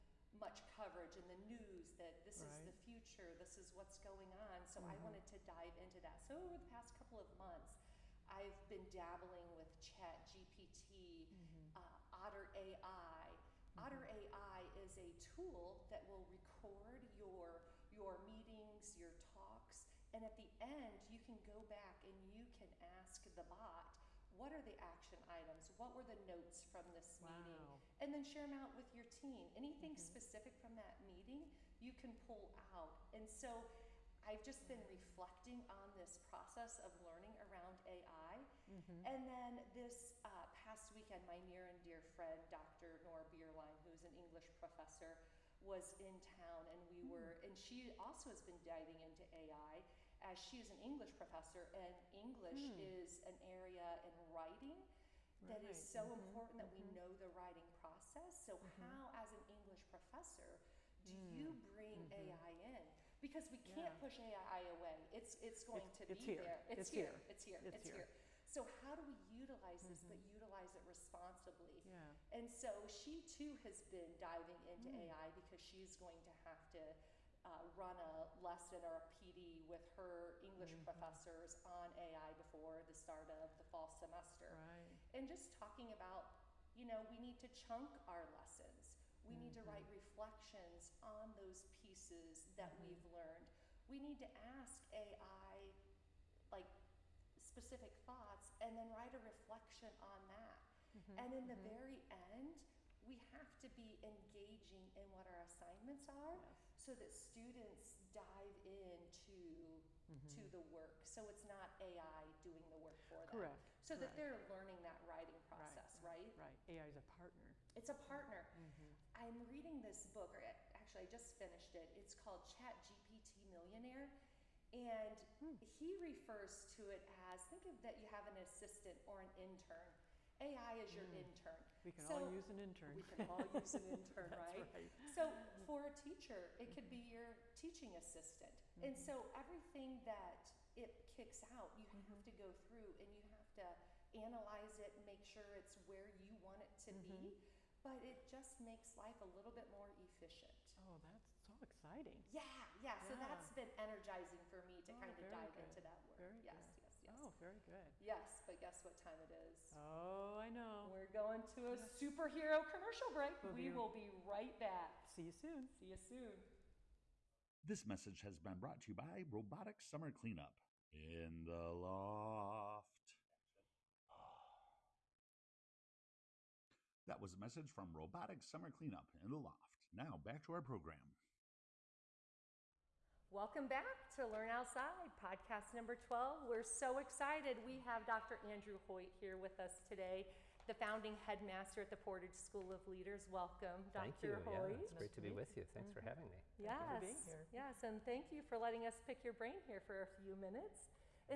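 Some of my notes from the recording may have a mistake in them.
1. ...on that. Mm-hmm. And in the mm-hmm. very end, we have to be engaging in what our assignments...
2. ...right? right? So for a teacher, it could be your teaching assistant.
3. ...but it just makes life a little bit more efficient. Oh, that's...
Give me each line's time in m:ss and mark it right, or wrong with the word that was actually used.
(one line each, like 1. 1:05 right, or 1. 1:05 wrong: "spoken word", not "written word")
1. 1:40 right
2. 2:14 right
3. 2:27 right.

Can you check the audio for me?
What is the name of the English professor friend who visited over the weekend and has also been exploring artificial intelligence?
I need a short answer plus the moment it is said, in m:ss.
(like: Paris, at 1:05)
Nora Bierlein, at 0:43.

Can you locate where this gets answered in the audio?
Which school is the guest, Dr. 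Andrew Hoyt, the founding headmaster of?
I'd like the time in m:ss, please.
3:11.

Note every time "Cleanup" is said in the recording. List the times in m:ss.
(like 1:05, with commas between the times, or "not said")
2:50, 2:58.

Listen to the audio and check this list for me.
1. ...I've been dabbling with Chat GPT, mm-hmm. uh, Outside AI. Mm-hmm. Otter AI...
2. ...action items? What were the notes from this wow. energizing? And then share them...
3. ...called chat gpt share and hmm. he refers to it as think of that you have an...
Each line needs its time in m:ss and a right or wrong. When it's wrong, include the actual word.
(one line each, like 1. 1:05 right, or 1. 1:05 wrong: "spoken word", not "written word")
1. 0:08 wrong: "Otter", not "Outside"
2. 0:24 wrong: "meeting", not "energizing"
3. 2:02 wrong: "millionaire", not "share".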